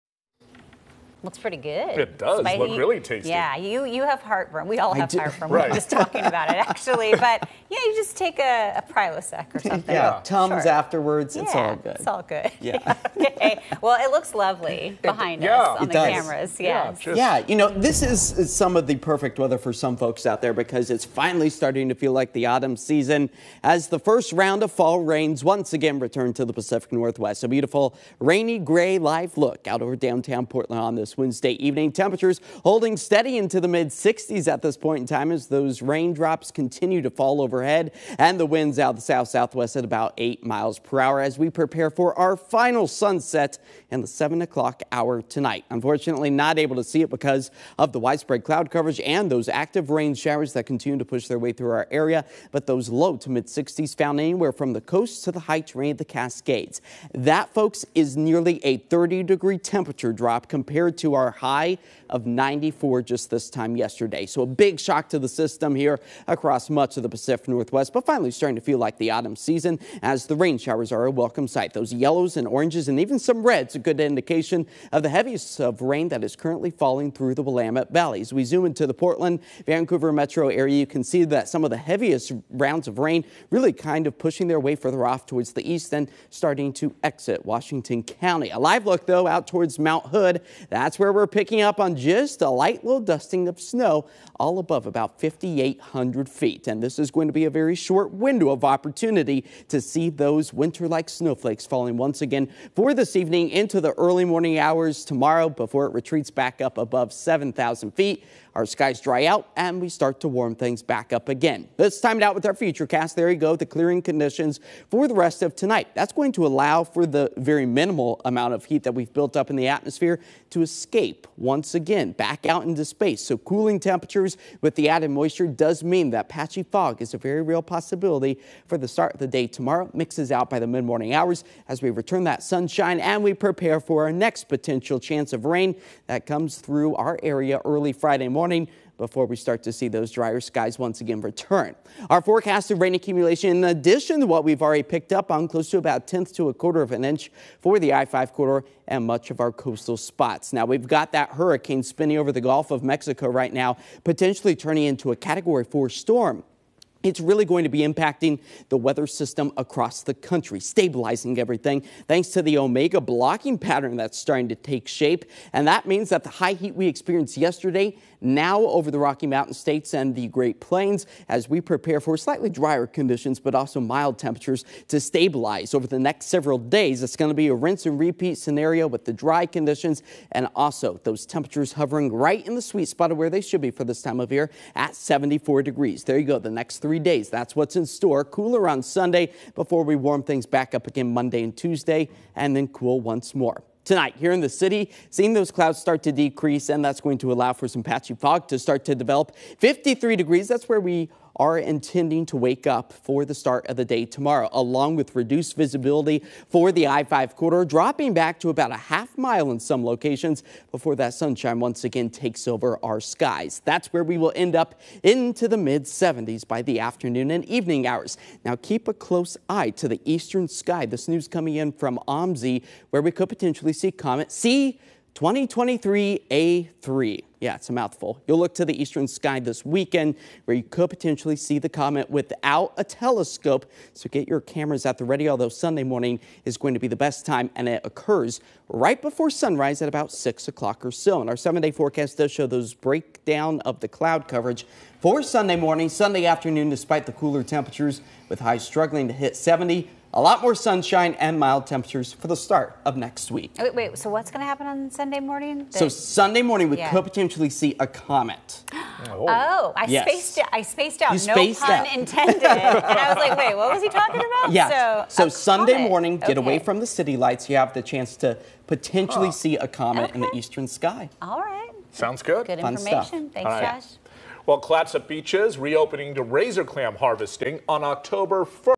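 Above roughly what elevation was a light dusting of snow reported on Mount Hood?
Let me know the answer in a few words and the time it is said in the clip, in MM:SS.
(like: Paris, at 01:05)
5,800 feet, at 01:35.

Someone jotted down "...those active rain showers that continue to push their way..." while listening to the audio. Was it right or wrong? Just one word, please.
right.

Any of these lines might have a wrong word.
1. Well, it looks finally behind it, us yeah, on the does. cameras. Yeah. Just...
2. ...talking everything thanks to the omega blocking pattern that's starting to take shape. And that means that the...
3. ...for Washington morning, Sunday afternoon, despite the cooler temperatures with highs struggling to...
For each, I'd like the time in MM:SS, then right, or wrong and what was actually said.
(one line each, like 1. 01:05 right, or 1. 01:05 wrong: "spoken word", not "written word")
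1. 00:13 wrong: "lovely", not "finally"
2. 02:40 wrong: "stabilizing", not "talking"
3. 04:04 wrong: "Sunday", not "Washington".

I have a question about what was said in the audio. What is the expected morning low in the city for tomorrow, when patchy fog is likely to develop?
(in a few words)
53 degrees.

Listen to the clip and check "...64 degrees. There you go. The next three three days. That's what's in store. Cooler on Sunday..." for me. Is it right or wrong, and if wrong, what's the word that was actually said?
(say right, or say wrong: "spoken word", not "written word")
wrong: "74", not "64".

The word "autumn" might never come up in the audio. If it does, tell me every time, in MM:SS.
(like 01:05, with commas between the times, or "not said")
00:22, 01:09.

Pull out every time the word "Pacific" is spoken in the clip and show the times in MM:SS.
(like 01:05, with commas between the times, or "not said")
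00:26, 01:07.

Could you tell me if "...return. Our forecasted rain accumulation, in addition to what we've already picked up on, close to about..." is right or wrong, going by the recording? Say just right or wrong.
right.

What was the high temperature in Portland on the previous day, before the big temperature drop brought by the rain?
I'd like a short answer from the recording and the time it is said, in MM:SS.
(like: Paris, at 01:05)
94, at 01:02.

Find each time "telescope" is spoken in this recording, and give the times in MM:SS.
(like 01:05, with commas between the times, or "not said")
03:52.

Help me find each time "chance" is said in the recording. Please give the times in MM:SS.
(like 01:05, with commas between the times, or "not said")
02:14, 04:27.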